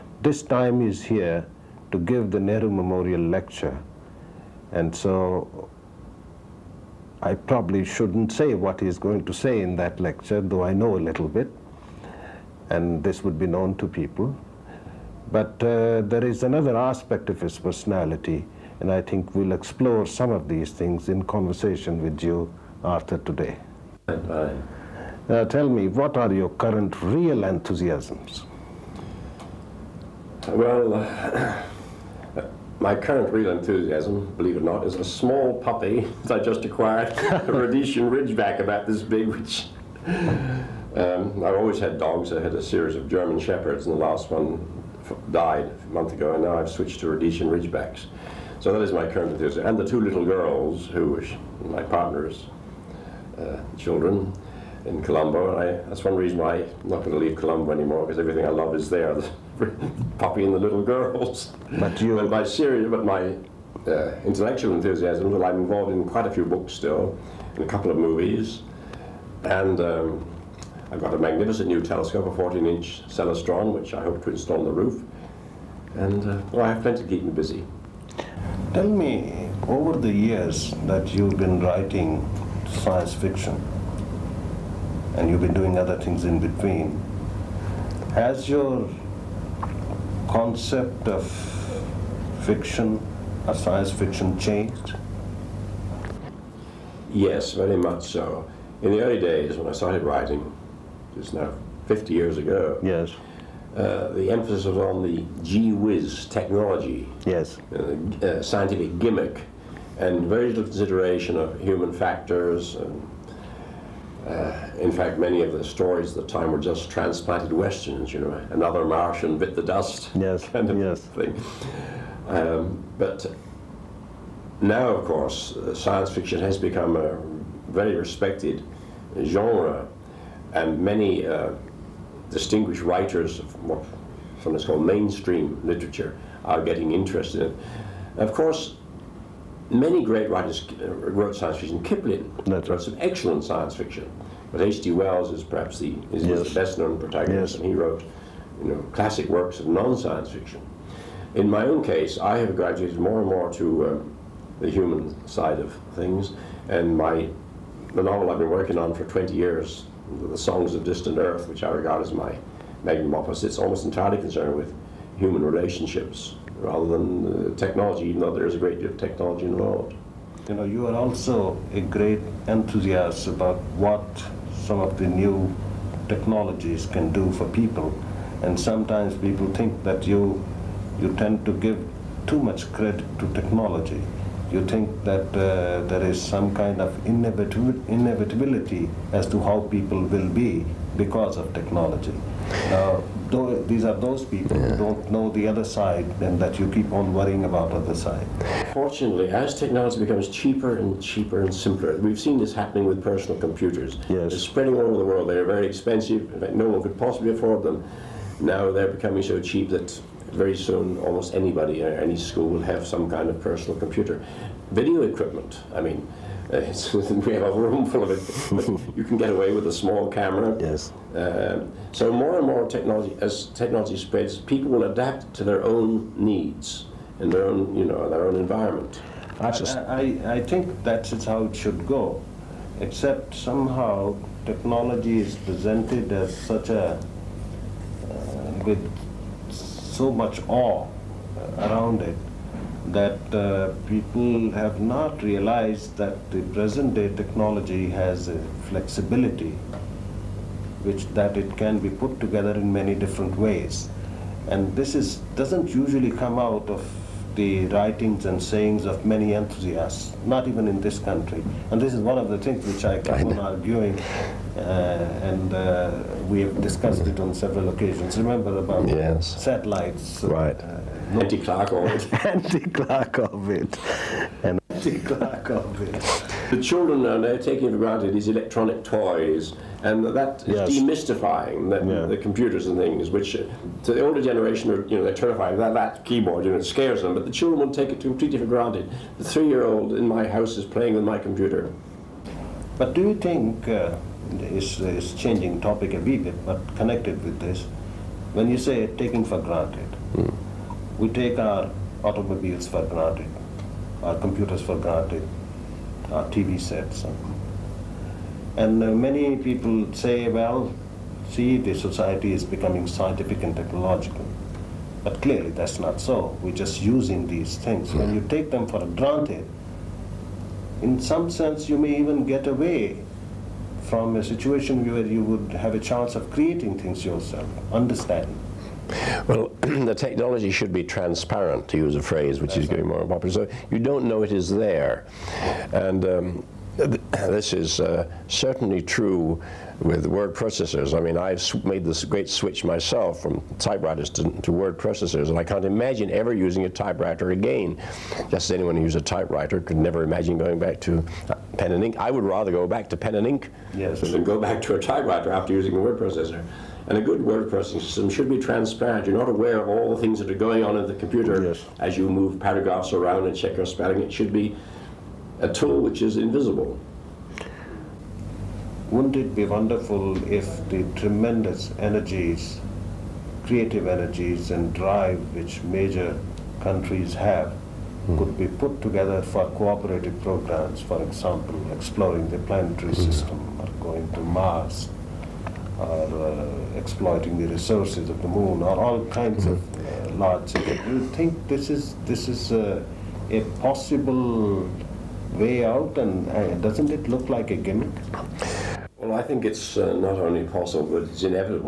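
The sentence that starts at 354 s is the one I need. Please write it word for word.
than go back to a typewriter after using a word processor.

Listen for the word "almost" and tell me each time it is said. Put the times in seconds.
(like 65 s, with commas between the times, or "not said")
163 s, 210 s.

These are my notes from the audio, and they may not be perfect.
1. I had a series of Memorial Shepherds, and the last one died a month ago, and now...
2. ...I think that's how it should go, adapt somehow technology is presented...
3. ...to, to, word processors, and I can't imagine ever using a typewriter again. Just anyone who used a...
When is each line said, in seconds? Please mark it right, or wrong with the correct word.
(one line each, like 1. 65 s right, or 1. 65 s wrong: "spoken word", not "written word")
1. 42 s wrong: "German", not "Memorial"
2. 230 s wrong: "except", not "adapt"
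3. 344 s right.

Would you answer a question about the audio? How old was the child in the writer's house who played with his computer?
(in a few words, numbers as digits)
3.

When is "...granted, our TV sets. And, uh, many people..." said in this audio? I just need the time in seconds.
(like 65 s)
304 s.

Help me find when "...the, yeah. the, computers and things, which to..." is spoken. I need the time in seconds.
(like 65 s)
281 s.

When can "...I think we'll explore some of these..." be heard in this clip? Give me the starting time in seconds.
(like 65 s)
18 s.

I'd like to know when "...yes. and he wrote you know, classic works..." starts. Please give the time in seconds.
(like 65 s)
147 s.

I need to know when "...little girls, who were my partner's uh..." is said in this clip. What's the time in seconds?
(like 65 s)
50 s.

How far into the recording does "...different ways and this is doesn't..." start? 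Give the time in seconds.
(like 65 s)
252 s.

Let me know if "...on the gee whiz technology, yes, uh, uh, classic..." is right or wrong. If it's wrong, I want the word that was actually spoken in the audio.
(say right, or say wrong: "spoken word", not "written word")
wrong: "scientific", not "classic".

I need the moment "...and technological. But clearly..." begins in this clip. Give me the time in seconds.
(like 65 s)
313 s.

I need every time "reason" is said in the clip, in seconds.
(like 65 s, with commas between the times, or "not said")
56 s.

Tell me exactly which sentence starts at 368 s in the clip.
Wouldn't it be wonderful if the tremendous energies, creative energies and drive which major countries have mm.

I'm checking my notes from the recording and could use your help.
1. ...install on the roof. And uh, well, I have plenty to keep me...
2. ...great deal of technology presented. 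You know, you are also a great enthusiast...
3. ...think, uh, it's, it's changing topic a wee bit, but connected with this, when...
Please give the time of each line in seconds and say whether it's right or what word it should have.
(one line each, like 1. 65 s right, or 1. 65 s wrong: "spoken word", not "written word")
1. 74 s right
2. 168 s wrong: "involved", not "presented"
3. 293 s right.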